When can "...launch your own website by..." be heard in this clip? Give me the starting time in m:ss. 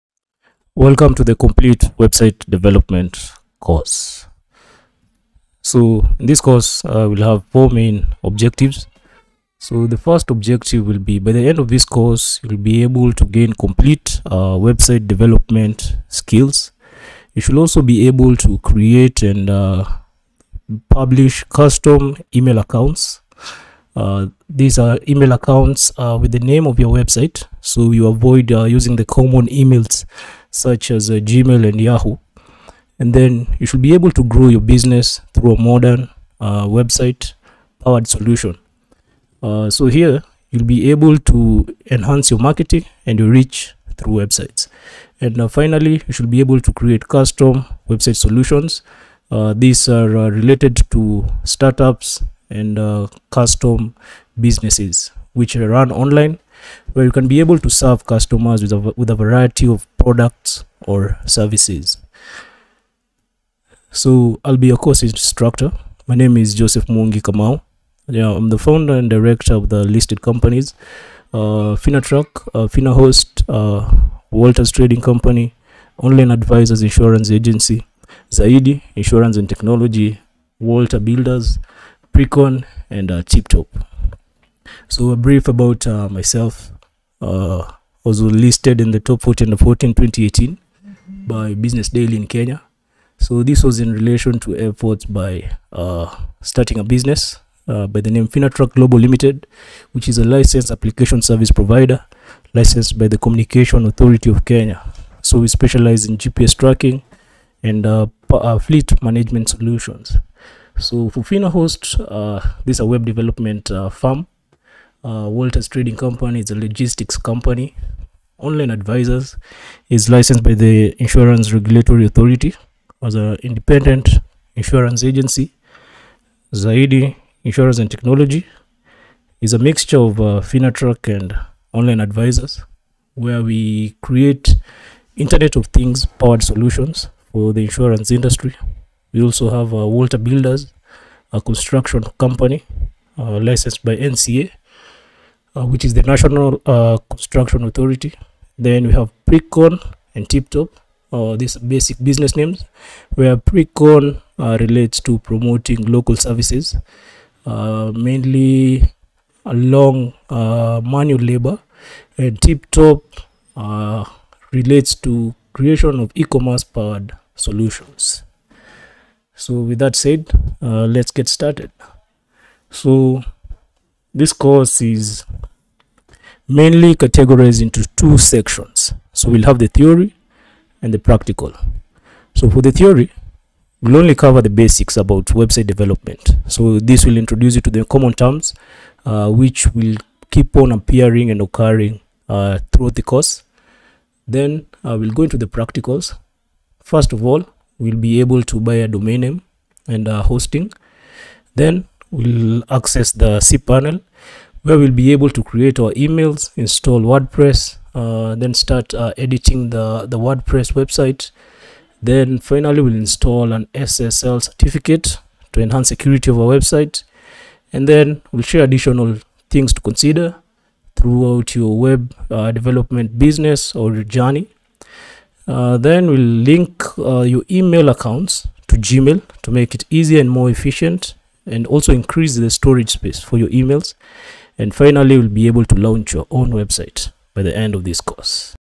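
3:55.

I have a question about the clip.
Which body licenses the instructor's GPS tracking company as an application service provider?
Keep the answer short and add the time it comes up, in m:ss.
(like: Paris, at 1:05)
Communication Authority of Kenya, at 1:43.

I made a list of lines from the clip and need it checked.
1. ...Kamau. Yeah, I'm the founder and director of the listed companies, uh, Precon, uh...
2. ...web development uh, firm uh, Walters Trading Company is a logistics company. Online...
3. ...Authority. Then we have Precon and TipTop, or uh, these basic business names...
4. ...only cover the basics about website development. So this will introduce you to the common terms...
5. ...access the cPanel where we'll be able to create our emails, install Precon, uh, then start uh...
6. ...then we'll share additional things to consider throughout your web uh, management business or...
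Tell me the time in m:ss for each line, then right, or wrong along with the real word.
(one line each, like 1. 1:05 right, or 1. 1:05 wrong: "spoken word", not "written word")
1. 1:07 wrong: "Finatrack", not "Precon"
2. 1:52 right
3. 2:27 right
4. 3:03 right
5. 3:22 wrong: "WordPress", not "Precon"
6. 3:37 wrong: "development", not "management".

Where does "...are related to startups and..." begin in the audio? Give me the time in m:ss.
0:49.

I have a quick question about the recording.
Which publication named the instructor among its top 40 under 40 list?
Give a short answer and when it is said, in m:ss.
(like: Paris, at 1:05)
Business Daily, at 1:31.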